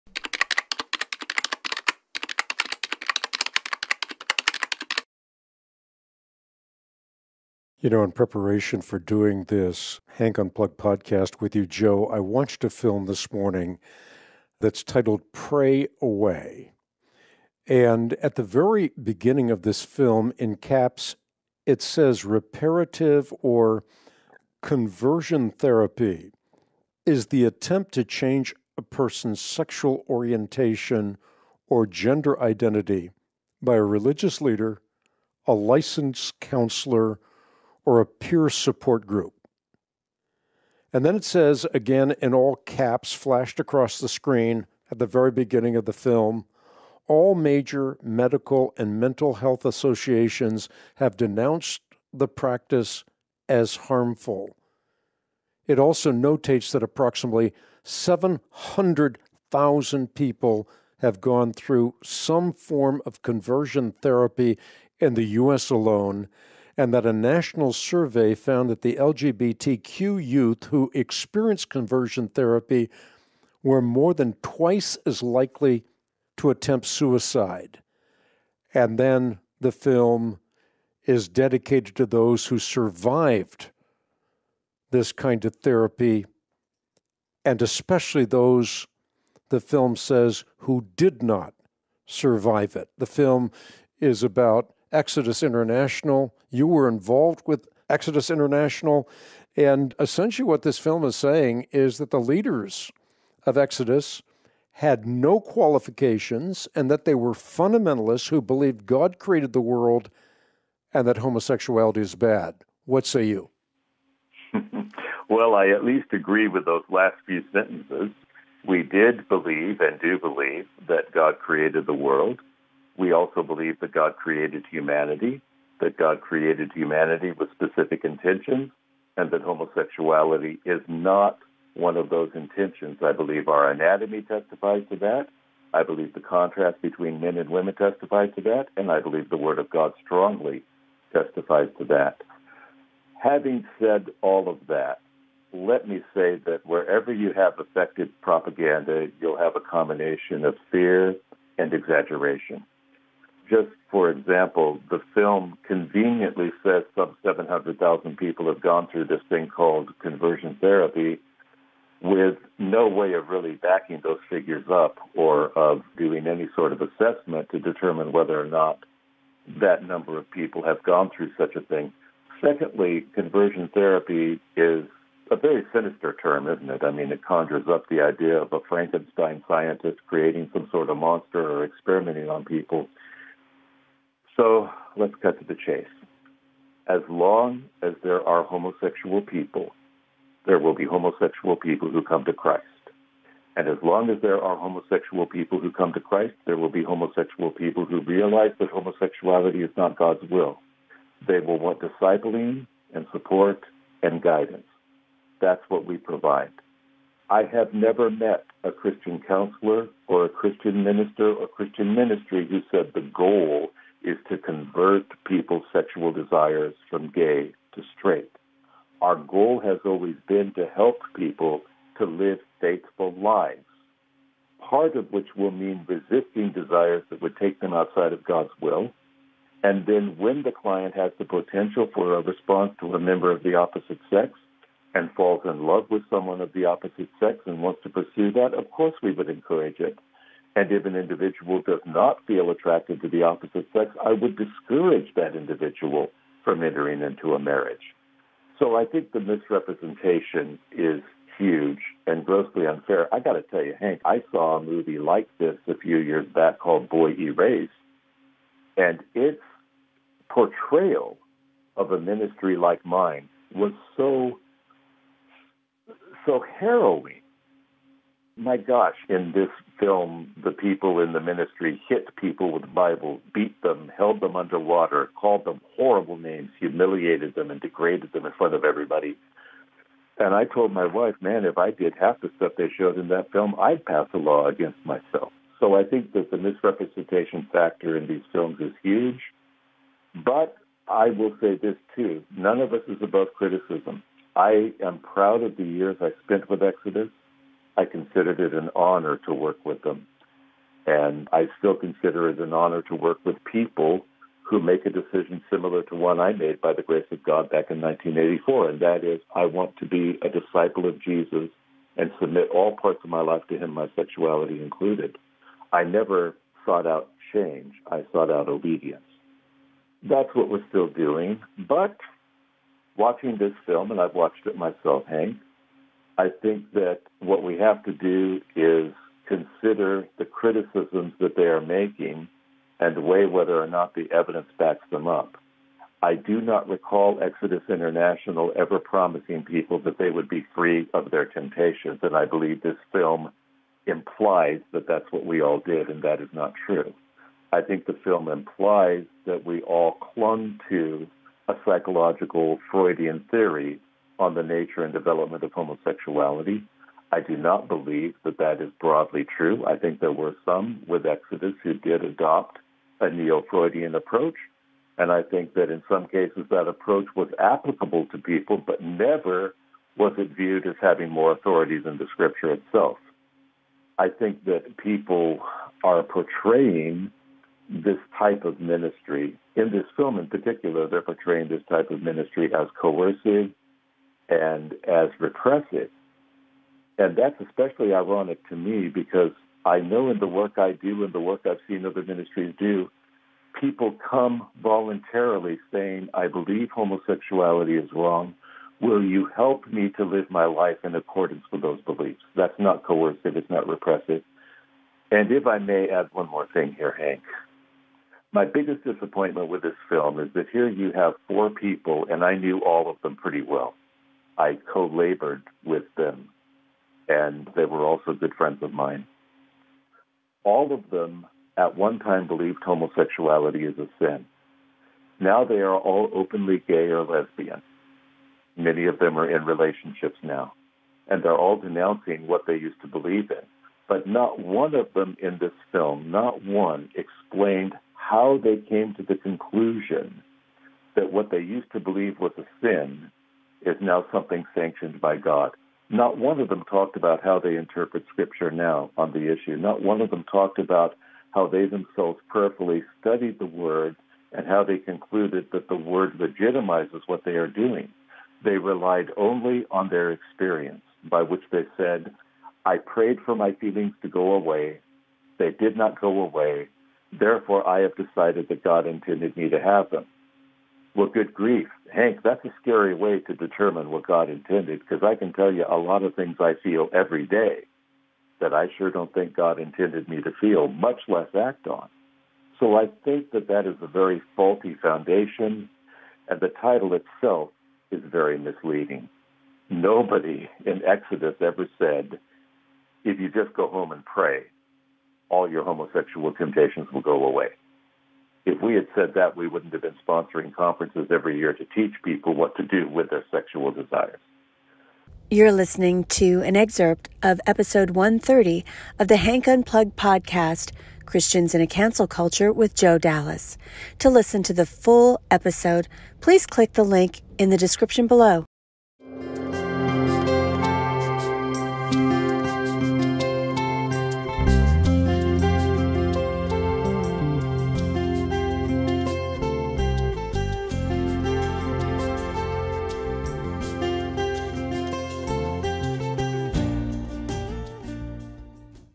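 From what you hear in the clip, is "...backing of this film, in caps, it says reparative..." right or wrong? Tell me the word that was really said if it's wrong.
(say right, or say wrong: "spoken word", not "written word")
wrong: "beginning", not "backing".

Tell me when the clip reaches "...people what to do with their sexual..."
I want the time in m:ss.
8:22.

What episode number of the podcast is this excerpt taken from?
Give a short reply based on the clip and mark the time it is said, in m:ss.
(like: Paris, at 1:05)
130, at 8:27.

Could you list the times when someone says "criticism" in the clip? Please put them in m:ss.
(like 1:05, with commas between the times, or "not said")
4:53, 5:30.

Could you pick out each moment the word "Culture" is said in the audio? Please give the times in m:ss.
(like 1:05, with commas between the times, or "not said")
8:32.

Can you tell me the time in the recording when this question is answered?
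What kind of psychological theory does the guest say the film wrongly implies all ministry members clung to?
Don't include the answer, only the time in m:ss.
5:52.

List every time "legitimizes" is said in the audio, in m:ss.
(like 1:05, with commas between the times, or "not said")
7:36.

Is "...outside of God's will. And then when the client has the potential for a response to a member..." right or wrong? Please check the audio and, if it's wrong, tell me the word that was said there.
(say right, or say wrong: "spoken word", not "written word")
right.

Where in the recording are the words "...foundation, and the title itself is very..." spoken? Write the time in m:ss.
8:04.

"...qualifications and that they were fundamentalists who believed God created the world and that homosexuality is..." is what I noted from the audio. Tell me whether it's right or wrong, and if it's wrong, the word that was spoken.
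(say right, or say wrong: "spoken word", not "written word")
right.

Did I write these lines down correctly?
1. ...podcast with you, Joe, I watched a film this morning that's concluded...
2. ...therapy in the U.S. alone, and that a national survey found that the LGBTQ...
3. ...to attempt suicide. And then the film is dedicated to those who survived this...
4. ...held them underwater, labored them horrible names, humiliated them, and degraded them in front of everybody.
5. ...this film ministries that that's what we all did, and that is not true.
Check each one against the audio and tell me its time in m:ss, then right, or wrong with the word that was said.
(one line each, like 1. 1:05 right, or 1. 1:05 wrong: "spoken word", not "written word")
1. 0:10 wrong: "titled", not "concluded"
2. 1:03 right
3. 1:16 right
4. 4:33 wrong: "called", not "labored"
5. 5:42 wrong: "implies", not "ministries".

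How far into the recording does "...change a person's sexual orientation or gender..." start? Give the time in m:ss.
0:28.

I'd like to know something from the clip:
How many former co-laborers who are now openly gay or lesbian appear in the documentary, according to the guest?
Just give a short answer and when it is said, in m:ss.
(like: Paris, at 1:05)
4, at 6:51.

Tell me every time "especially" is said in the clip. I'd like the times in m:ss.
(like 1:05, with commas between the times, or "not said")
1:27, 6:27.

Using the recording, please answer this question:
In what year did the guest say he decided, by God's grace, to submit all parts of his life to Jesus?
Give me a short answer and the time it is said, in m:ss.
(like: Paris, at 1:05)
1984, at 5:07.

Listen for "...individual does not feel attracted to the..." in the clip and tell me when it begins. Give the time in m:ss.
4:00.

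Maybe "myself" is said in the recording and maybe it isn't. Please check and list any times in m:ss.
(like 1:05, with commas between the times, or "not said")
4:44, 5:24.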